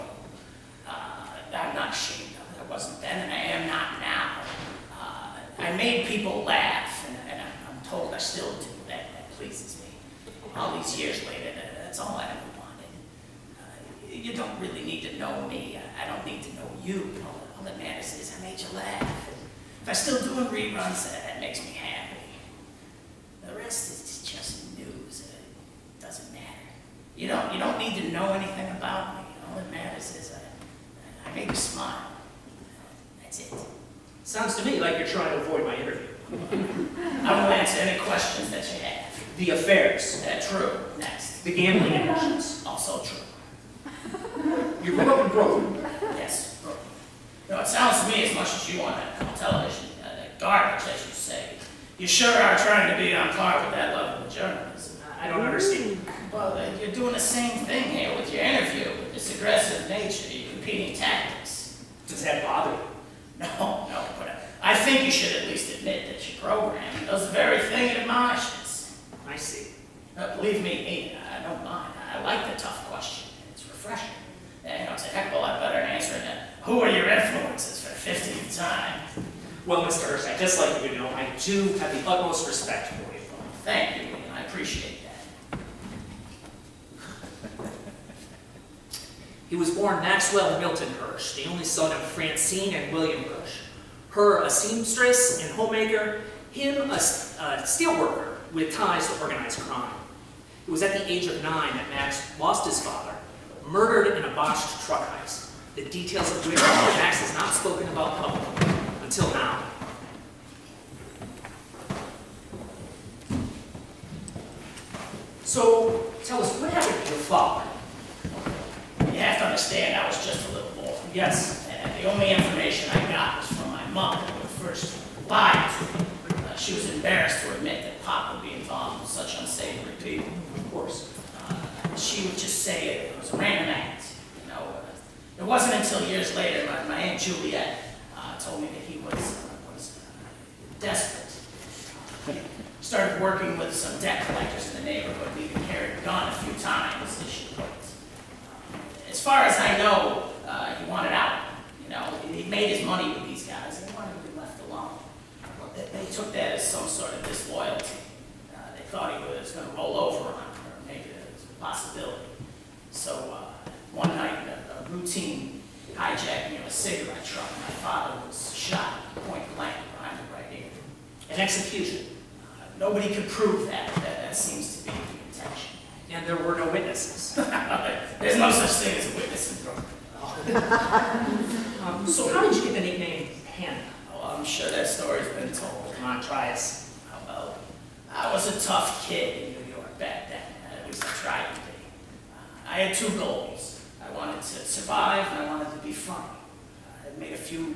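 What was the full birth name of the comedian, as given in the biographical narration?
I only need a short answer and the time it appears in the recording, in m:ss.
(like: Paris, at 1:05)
Maxwell Milton Hirsch, at 1:30.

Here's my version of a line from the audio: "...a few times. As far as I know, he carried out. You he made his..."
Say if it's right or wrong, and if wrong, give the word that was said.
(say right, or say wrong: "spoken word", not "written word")
wrong: "wanted", not "carried".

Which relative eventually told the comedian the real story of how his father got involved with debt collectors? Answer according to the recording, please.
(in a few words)
Aunt Juliet.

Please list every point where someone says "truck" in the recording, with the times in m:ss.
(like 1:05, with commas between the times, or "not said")
1:44, 2:47.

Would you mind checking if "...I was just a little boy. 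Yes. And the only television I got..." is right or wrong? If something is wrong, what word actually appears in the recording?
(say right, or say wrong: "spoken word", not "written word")
wrong: "information", not "television".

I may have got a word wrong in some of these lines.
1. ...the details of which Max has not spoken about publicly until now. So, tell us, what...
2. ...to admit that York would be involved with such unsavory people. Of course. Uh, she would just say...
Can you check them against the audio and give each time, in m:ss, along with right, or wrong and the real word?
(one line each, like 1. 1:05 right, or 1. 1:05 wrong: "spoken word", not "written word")
1. 1:45 right
2. 2:07 wrong: "Pop", not "York".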